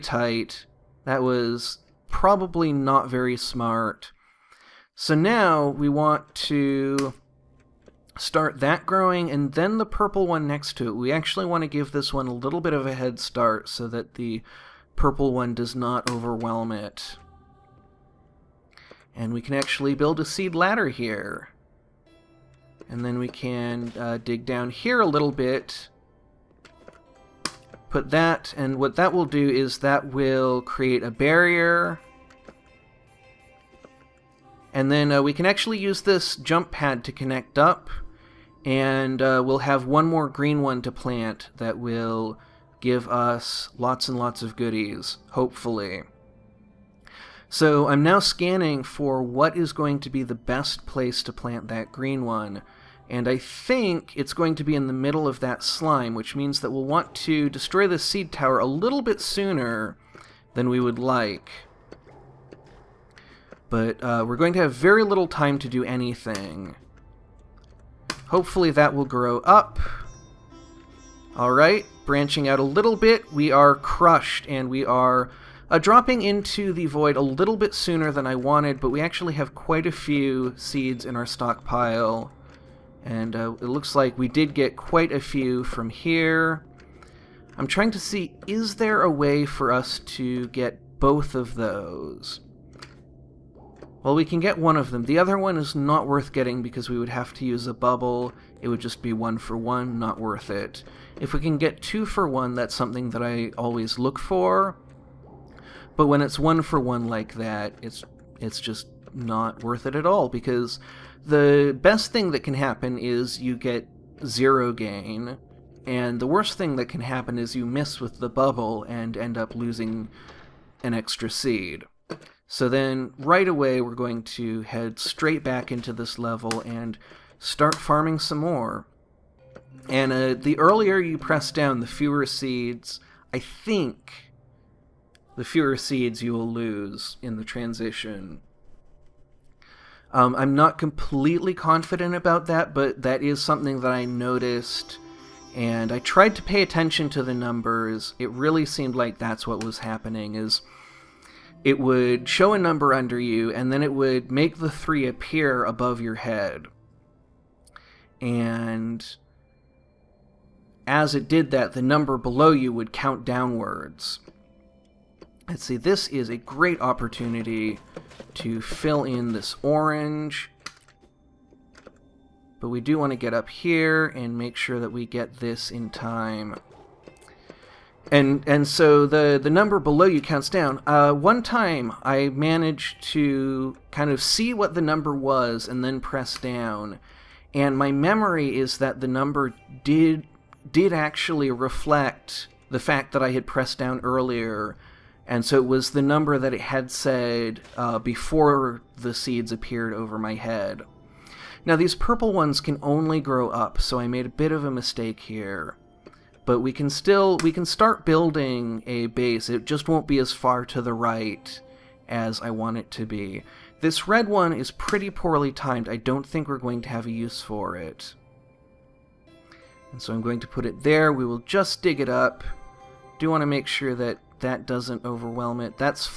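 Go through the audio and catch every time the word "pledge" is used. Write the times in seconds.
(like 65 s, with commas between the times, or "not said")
not said.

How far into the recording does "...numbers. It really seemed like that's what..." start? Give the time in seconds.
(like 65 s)
147 s.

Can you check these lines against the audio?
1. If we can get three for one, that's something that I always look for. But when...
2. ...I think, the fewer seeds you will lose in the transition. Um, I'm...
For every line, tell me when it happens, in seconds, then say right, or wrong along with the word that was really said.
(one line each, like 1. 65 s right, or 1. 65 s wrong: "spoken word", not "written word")
1. 101 s wrong: "two", not "three"
2. 133 s right.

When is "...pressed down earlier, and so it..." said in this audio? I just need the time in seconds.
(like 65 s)
193 s.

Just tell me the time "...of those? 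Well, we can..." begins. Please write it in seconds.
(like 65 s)
91 s.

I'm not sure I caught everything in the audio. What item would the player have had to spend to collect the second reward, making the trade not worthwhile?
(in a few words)
A bubble.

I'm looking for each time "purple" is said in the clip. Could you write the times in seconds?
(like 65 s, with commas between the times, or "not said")
9 s, 14 s, 201 s.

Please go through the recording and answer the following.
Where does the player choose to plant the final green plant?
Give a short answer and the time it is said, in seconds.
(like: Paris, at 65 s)
In the middle of that slime, at 54 s.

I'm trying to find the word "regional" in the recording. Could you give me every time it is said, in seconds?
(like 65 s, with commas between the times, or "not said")
not said.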